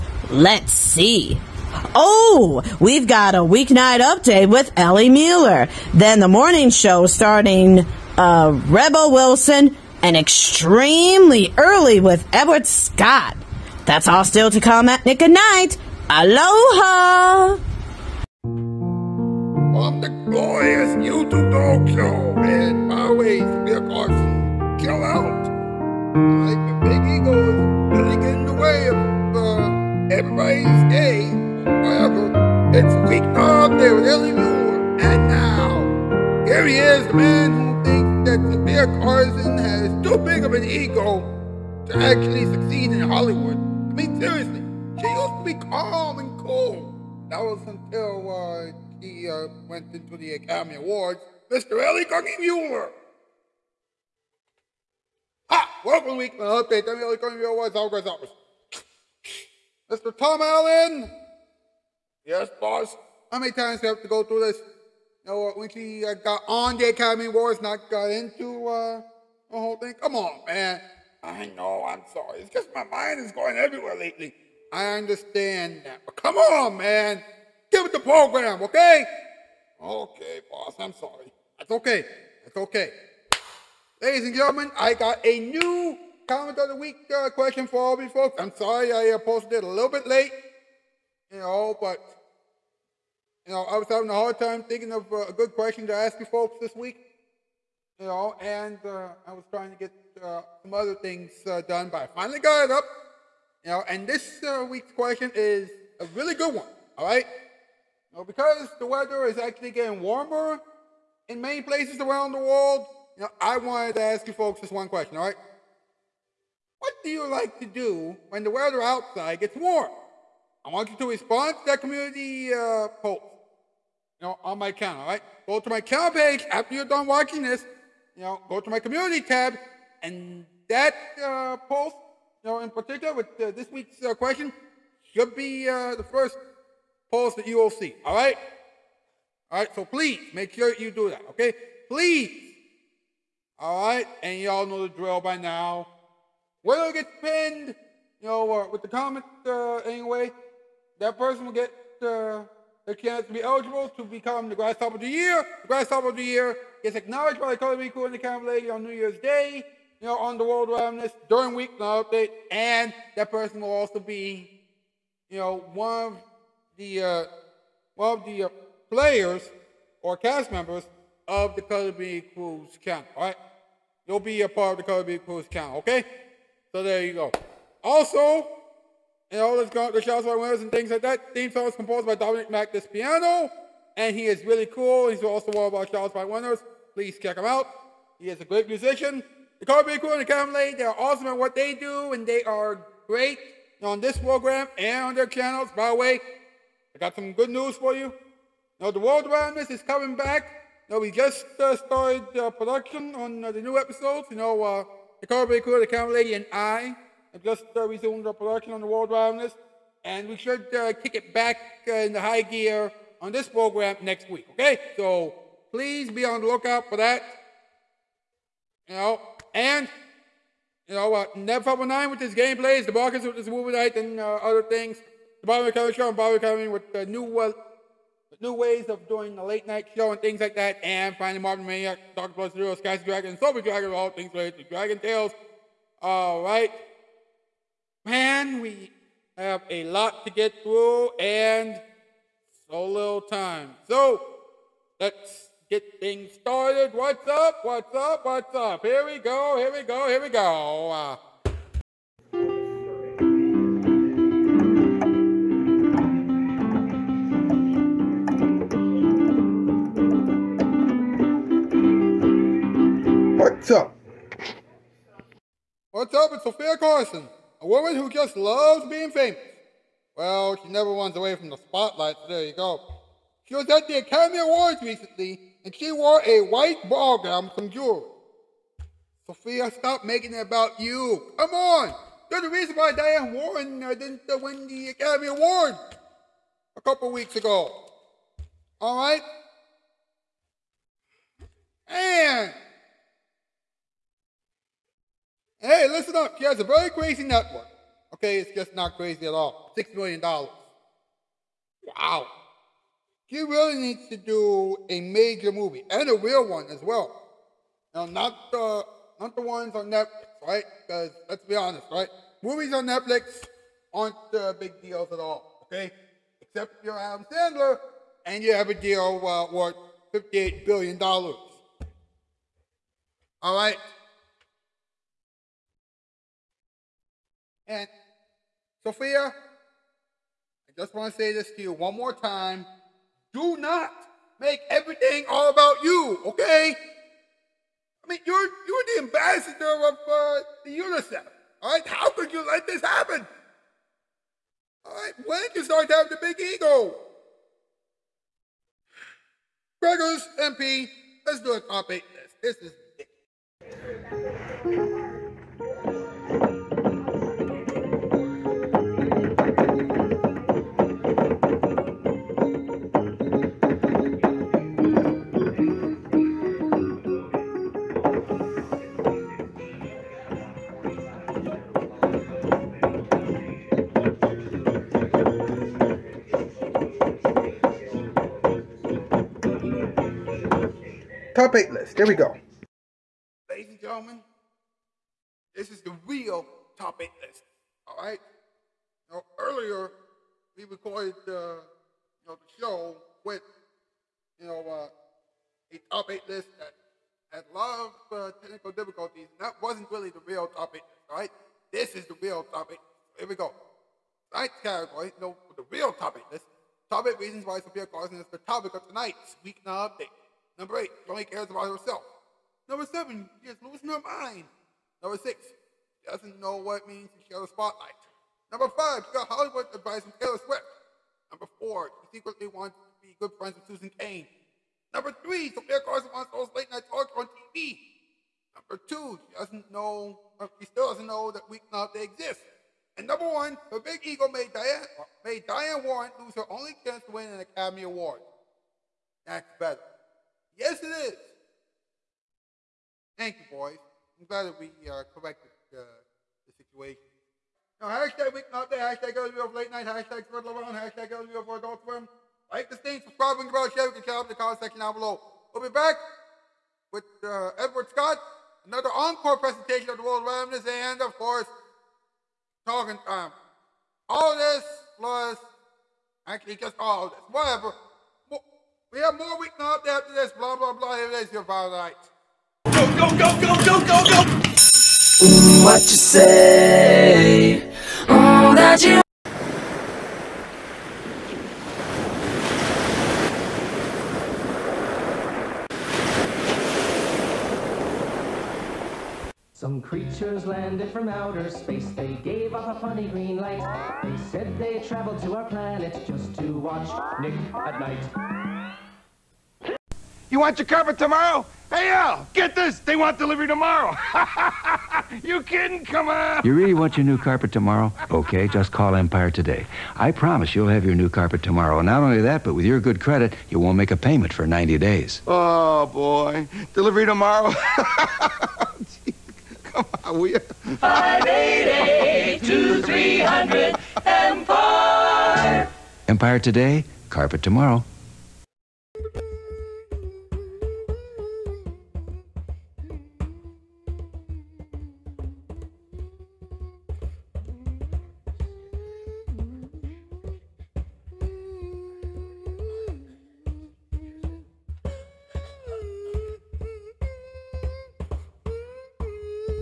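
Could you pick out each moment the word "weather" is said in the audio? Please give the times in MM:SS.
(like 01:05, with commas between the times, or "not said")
01:48, 01:58.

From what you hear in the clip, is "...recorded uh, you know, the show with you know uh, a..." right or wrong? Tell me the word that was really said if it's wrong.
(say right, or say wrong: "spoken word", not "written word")
right.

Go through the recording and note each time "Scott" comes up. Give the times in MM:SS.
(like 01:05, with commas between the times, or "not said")
00:12, 07:37.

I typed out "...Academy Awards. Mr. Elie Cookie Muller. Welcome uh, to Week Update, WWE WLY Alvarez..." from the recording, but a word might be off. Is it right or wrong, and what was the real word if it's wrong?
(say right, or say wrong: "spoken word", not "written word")
right.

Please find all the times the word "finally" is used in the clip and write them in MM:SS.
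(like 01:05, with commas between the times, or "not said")
01:42, 03:51.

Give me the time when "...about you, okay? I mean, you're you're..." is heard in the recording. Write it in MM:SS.
05:35.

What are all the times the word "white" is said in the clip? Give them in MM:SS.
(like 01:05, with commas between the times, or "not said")
04:36.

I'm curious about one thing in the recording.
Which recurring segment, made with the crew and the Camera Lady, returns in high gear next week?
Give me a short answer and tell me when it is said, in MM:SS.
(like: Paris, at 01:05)
World Roundness, at 03:28.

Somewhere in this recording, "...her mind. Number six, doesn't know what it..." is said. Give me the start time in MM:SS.
06:53.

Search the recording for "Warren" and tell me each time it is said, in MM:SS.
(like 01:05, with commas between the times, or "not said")
04:43, 07:15.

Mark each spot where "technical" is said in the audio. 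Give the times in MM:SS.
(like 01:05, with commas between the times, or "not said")
06:38.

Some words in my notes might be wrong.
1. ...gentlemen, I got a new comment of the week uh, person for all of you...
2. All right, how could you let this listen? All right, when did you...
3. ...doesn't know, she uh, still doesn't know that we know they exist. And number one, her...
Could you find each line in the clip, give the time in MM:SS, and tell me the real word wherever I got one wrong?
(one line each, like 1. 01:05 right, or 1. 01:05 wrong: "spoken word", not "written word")
1. 01:24 wrong: "question", not "person"
2. 05:41 wrong: "happen", not "listen"
3. 07:09 right.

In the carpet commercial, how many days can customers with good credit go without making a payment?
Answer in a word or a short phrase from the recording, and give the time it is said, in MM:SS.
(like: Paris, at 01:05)
90, at 08:34.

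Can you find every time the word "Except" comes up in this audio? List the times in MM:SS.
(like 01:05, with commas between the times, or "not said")
05:16.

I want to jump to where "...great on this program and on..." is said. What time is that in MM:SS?
03:13.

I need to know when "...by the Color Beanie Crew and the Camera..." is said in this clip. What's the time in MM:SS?
02:37.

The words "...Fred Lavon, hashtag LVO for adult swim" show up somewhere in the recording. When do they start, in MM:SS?
07:30.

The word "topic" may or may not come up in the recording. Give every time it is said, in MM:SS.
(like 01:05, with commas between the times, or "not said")
05:51, 06:48.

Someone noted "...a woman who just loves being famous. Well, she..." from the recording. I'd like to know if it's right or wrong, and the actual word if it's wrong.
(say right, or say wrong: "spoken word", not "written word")
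right.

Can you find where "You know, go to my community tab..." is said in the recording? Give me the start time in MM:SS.
02:08.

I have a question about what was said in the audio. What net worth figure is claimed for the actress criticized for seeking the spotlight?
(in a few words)
$6 million.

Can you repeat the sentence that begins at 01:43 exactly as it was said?
And this week's question is a really good one, all right?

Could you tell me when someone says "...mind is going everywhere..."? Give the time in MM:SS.
01:12.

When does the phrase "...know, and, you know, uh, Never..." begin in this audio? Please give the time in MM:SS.
03:38.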